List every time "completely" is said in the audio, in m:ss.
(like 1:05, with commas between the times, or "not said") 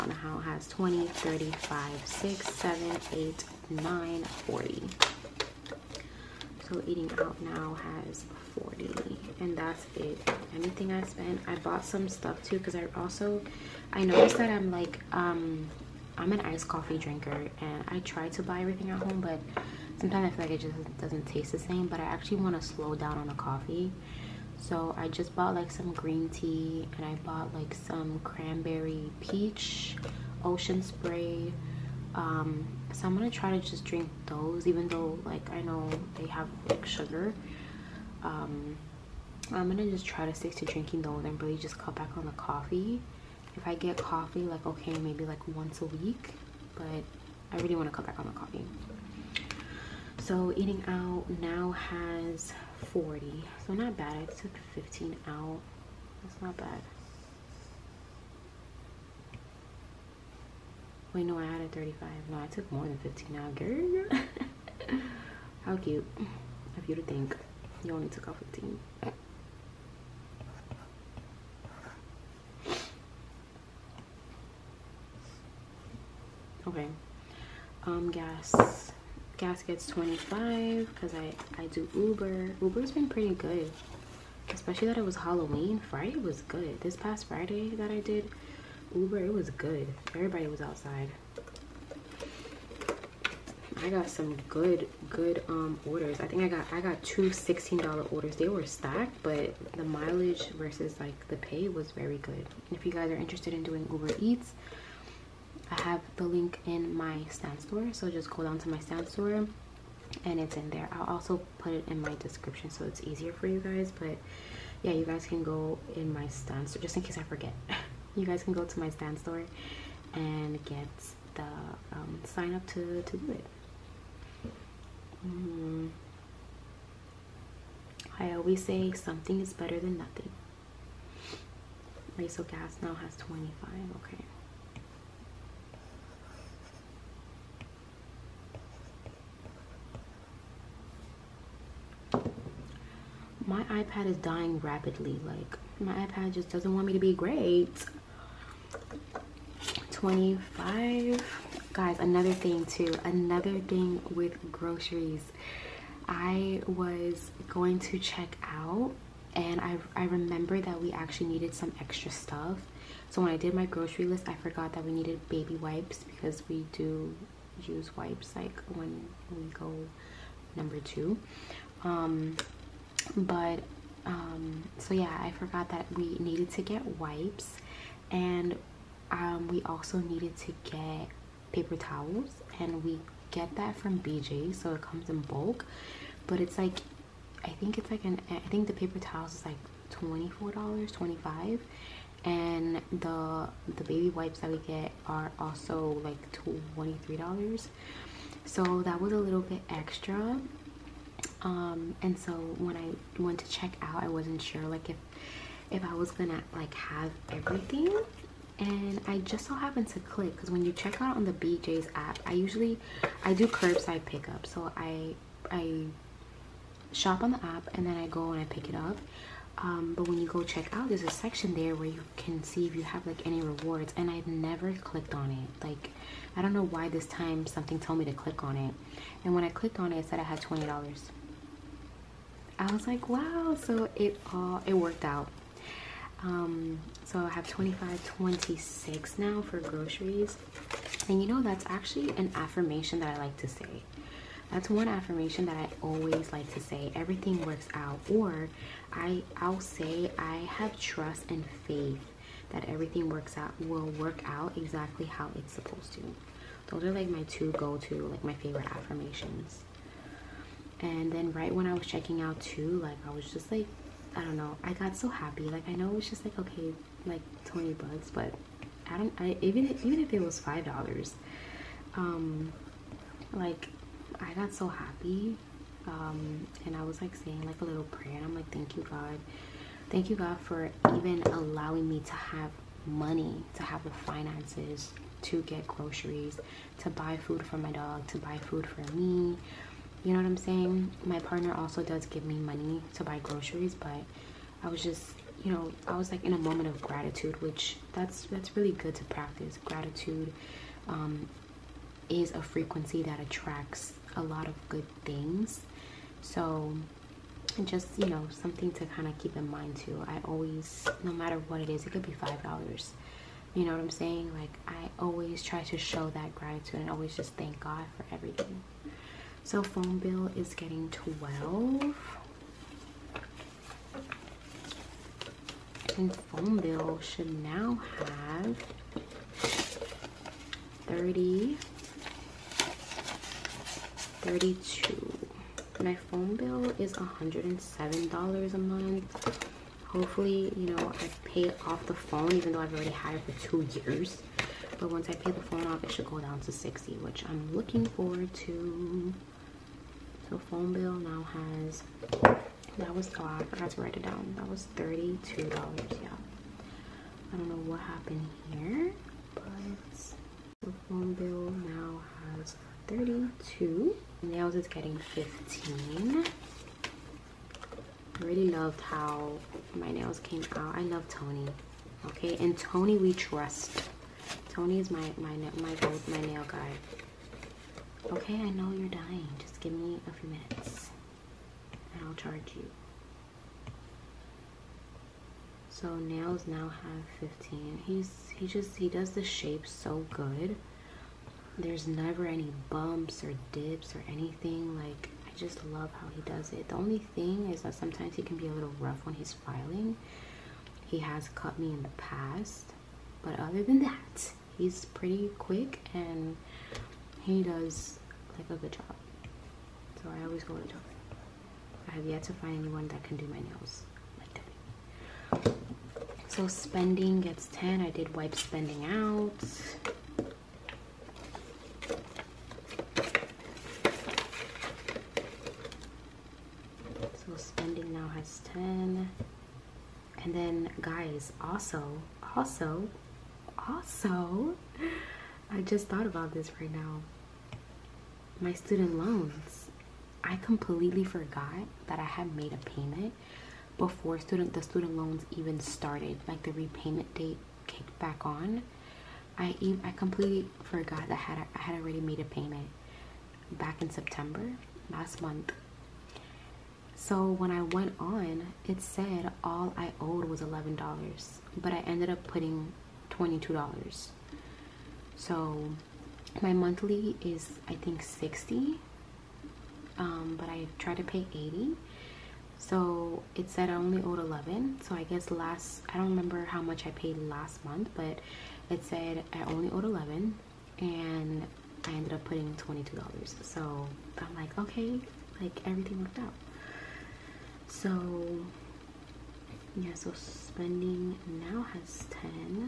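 7:20, 7:29.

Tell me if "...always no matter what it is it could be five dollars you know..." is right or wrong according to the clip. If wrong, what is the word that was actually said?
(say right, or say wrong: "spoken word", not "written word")
right.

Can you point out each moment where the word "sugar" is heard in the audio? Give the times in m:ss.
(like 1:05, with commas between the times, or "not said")
0:36.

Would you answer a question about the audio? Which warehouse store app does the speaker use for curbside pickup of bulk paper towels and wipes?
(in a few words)
BJ's.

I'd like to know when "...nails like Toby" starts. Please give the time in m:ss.
6:53.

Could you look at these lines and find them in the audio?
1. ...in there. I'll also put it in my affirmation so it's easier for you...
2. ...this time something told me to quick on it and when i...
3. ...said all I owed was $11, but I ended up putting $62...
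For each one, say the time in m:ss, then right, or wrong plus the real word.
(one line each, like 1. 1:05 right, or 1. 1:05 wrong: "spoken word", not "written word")
1. 1:50 wrong: "description", not "affirmation"
2. 3:46 wrong: "click", not "quick"
3. 7:38 wrong: "22", not "62".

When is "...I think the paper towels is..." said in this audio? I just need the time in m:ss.
3:08.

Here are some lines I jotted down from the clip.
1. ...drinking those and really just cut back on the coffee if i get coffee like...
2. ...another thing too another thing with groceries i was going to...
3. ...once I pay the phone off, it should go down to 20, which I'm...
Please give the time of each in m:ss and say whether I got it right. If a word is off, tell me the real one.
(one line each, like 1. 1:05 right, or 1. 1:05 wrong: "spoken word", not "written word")
1. 0:40 right
2. 2:31 right
3. 5:44 wrong: "60", not "20".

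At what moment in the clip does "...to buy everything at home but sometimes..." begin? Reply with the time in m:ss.
0:18.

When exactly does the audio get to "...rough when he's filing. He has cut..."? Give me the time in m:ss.
6:38.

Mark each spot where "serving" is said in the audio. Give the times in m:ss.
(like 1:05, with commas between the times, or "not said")
not said.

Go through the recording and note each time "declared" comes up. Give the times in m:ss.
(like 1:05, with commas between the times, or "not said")
not said.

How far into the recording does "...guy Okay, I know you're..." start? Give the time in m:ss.
6:16.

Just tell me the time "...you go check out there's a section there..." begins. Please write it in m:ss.
3:40.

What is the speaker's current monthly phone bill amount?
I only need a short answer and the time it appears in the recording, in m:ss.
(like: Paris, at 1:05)
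$107, at 5:36.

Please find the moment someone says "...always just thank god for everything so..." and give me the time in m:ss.
5:16.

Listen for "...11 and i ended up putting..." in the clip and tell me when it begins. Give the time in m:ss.
7:59.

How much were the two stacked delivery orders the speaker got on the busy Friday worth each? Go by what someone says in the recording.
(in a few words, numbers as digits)
$16.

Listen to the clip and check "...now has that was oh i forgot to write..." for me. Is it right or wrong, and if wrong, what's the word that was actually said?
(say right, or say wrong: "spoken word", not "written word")
right.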